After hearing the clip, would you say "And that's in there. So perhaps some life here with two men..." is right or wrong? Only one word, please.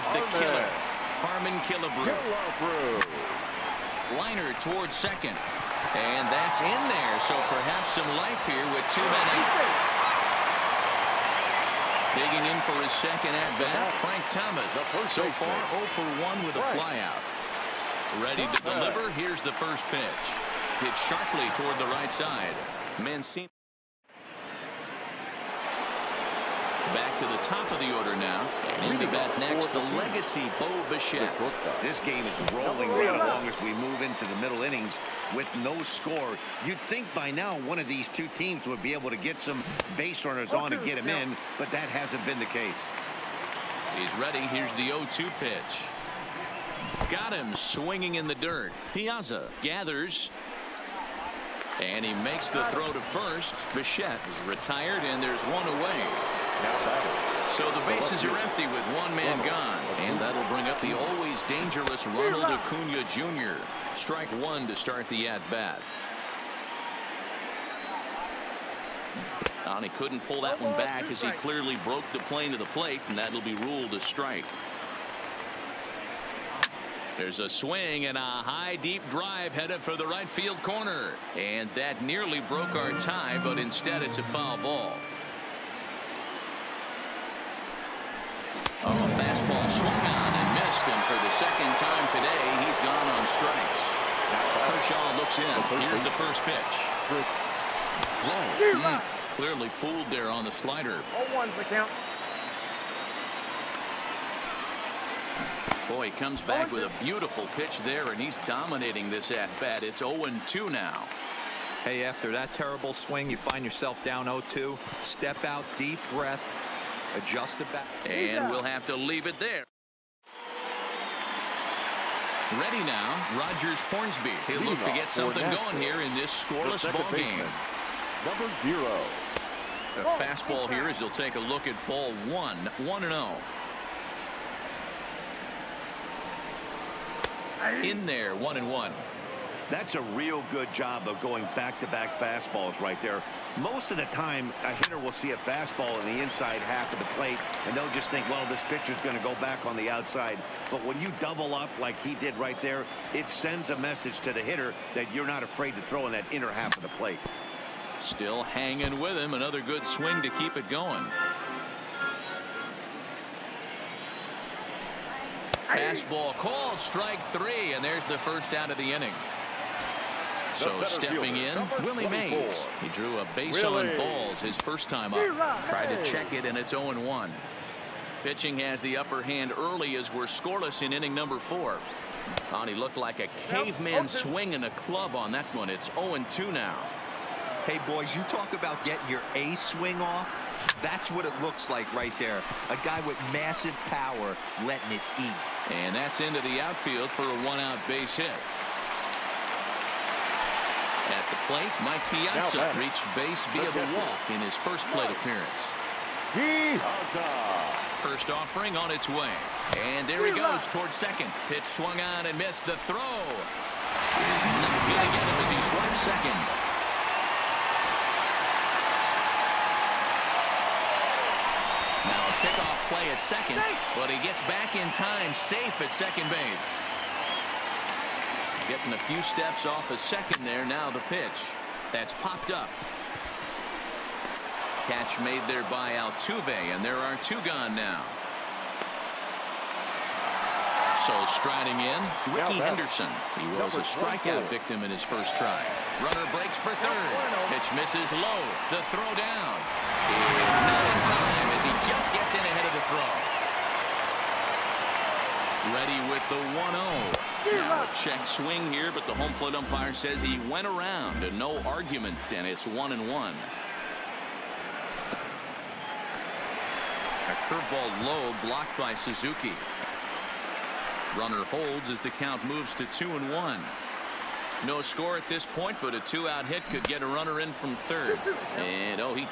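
right.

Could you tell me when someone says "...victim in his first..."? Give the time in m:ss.
4:04.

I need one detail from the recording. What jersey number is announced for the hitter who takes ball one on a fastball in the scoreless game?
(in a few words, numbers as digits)
0.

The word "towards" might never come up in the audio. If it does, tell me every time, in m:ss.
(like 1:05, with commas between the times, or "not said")
0:04, 0:21, 3:30.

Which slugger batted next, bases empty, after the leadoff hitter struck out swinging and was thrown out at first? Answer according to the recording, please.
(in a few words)
Ronald Acuna Jr.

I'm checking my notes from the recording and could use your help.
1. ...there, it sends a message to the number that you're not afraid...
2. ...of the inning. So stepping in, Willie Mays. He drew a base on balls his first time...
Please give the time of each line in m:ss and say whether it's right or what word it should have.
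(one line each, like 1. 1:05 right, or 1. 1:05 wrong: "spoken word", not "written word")
1. 2:32 wrong: "hitter", not "number"
2. 2:48 right.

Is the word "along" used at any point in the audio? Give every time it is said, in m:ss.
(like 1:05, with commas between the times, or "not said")
0:33.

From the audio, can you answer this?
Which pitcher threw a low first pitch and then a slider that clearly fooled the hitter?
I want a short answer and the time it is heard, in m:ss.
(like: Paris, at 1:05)
Kershaw, at 1:34.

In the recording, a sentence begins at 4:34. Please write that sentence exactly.
No score at this point, but a two-out hit could get a runner in from third.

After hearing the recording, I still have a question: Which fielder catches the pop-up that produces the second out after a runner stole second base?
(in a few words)
Altuve.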